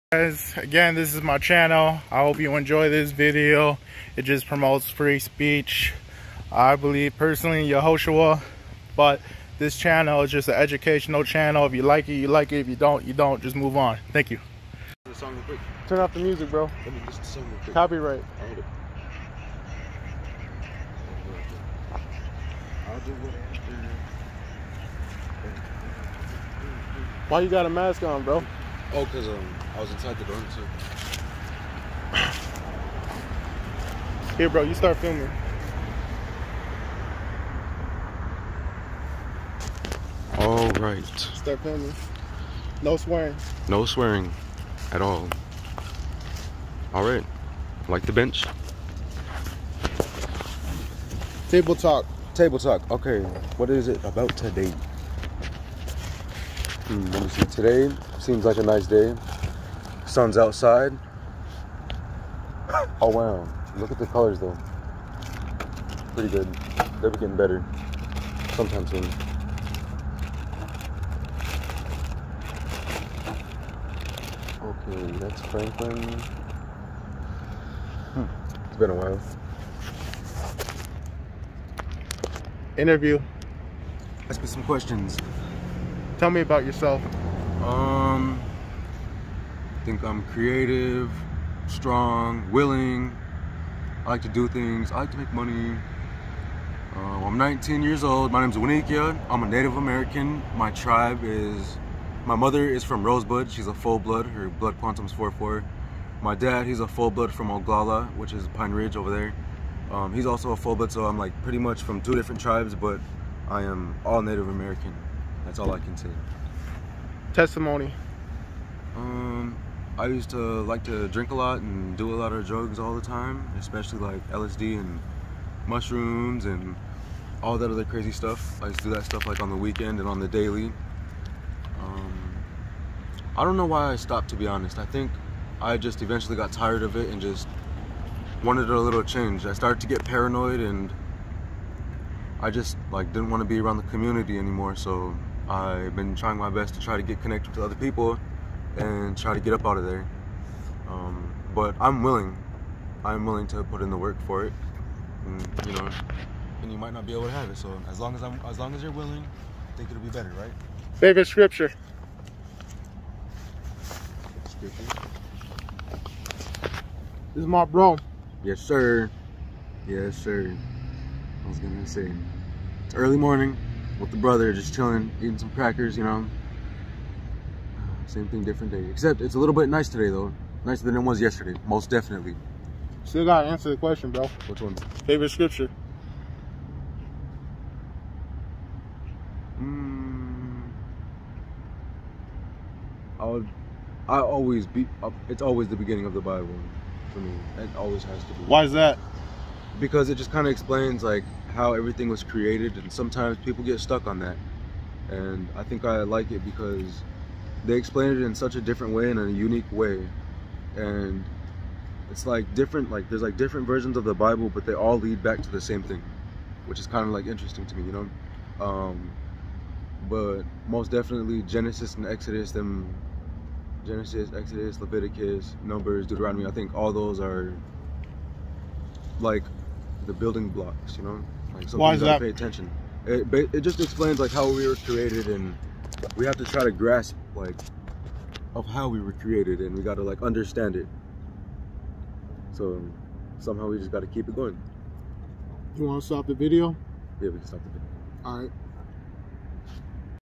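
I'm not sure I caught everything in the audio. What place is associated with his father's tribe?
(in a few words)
Pine Ridge.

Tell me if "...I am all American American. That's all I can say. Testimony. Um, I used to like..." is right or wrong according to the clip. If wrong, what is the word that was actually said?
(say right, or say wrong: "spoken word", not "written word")
wrong: "Native", not "American".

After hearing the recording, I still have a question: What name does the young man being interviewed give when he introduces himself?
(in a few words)
Wanikiya.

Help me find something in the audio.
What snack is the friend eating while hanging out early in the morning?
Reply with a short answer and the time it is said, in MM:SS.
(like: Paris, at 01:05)
Crackers, at 02:55.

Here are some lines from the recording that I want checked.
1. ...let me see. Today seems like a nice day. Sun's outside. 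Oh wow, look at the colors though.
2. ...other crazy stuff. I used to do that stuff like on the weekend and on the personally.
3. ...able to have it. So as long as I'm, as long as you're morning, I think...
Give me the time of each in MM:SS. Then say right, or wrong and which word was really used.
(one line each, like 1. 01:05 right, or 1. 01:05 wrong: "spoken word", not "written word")
1. 00:57 right
2. 02:07 wrong: "daily", not "personally"
3. 02:37 wrong: "willing", not "morning".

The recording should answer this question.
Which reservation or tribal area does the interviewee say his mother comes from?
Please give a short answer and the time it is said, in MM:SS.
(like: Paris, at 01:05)
Rosebud, at 01:43.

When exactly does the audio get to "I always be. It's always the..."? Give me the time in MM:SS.
03:14.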